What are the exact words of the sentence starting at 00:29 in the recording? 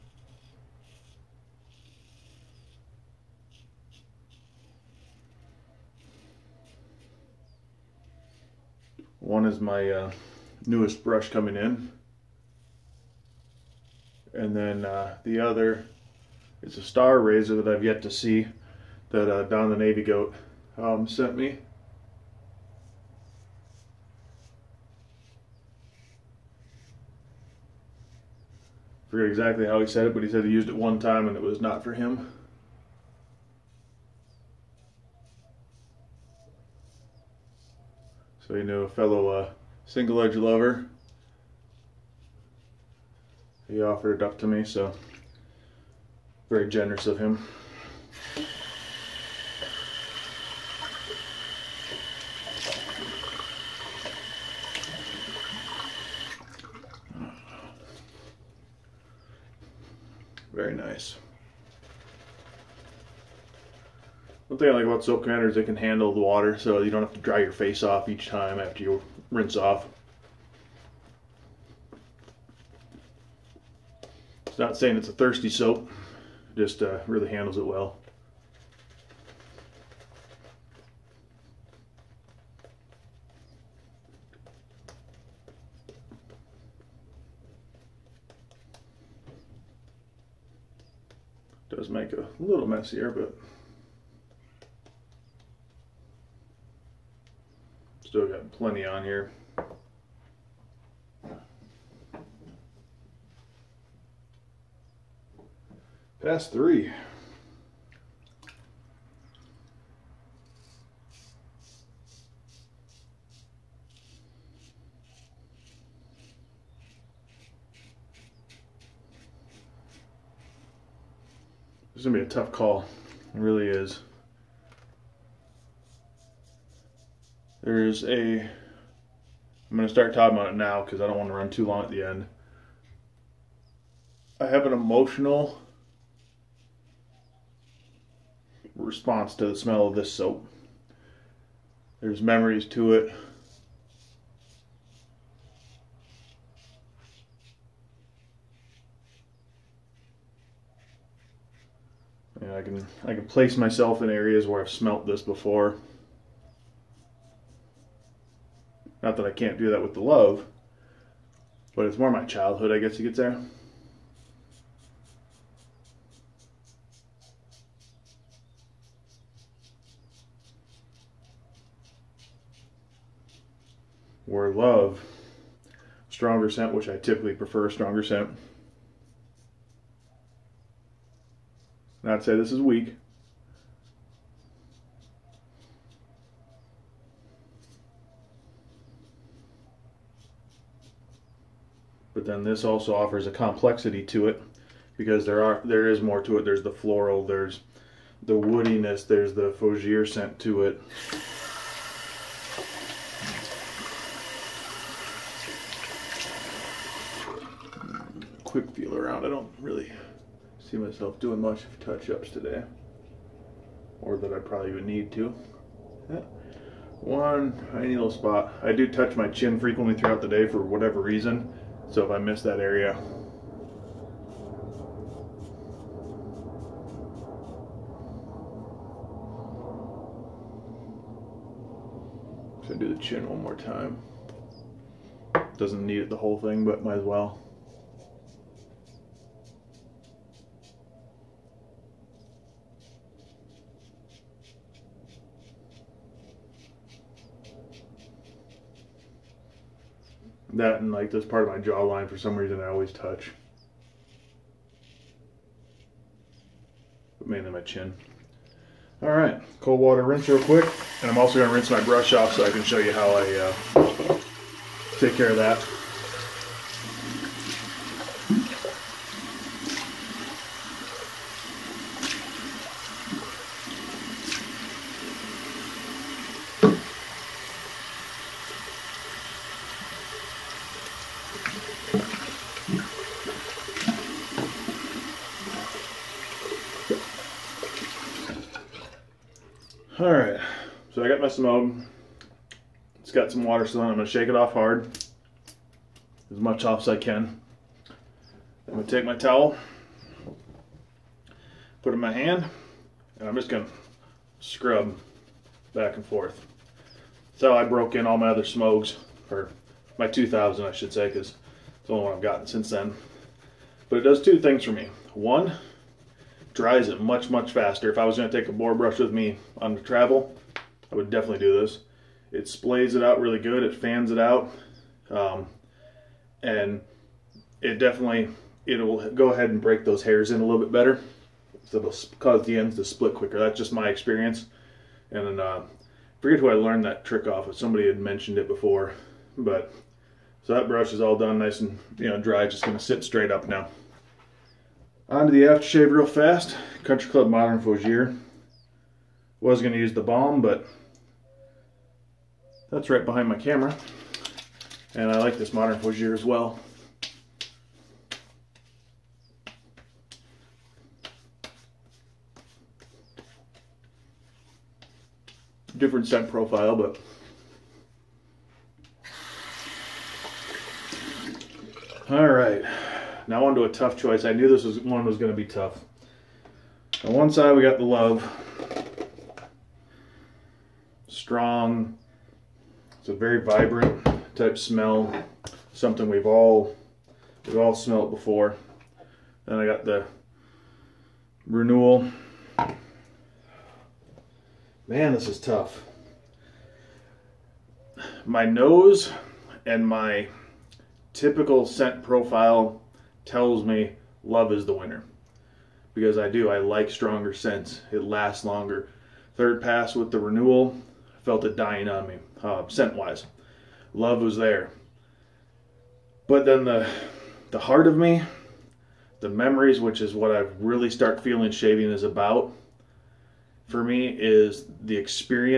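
I forget exactly how he said it, but he said he used it one time and it was not for him.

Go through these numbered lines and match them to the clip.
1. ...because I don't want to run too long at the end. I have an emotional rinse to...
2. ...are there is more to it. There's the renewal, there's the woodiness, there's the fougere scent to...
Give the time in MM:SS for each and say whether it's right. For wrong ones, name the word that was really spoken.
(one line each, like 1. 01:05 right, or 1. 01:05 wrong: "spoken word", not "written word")
1. 02:10 wrong: "response", not "rinse"
2. 03:15 wrong: "floral", not "renewal".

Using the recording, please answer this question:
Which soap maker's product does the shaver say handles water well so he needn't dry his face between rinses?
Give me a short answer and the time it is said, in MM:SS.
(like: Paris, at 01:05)
Soap grinders, at 01:05.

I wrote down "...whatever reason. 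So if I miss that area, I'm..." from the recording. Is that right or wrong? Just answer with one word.
right.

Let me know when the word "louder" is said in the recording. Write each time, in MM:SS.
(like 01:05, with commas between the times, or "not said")
not said.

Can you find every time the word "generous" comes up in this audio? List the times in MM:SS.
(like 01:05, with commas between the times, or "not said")
00:46.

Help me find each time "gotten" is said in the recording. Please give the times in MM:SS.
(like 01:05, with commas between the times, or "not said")
05:12.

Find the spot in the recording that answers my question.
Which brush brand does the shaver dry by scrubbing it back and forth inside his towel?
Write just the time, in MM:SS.
04:51.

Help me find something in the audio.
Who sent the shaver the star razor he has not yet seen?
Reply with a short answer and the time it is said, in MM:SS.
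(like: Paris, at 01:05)
Don the Navy Goat, at 00:19.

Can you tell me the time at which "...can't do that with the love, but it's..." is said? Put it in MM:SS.
02:39.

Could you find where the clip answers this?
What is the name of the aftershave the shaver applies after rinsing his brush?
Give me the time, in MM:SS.
05:46.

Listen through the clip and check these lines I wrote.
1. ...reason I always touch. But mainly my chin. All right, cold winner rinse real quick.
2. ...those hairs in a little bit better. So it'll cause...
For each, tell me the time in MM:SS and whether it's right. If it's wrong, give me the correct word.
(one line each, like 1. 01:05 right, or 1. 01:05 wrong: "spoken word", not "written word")
1. 04:12 wrong: "water", not "winner"
2. 05:29 right.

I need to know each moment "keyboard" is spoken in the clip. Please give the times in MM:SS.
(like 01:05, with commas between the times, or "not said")
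not said.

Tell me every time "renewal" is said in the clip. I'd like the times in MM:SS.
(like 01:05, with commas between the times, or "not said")
06:31, 06:50.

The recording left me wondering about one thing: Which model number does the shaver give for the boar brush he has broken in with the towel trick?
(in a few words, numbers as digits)
2000.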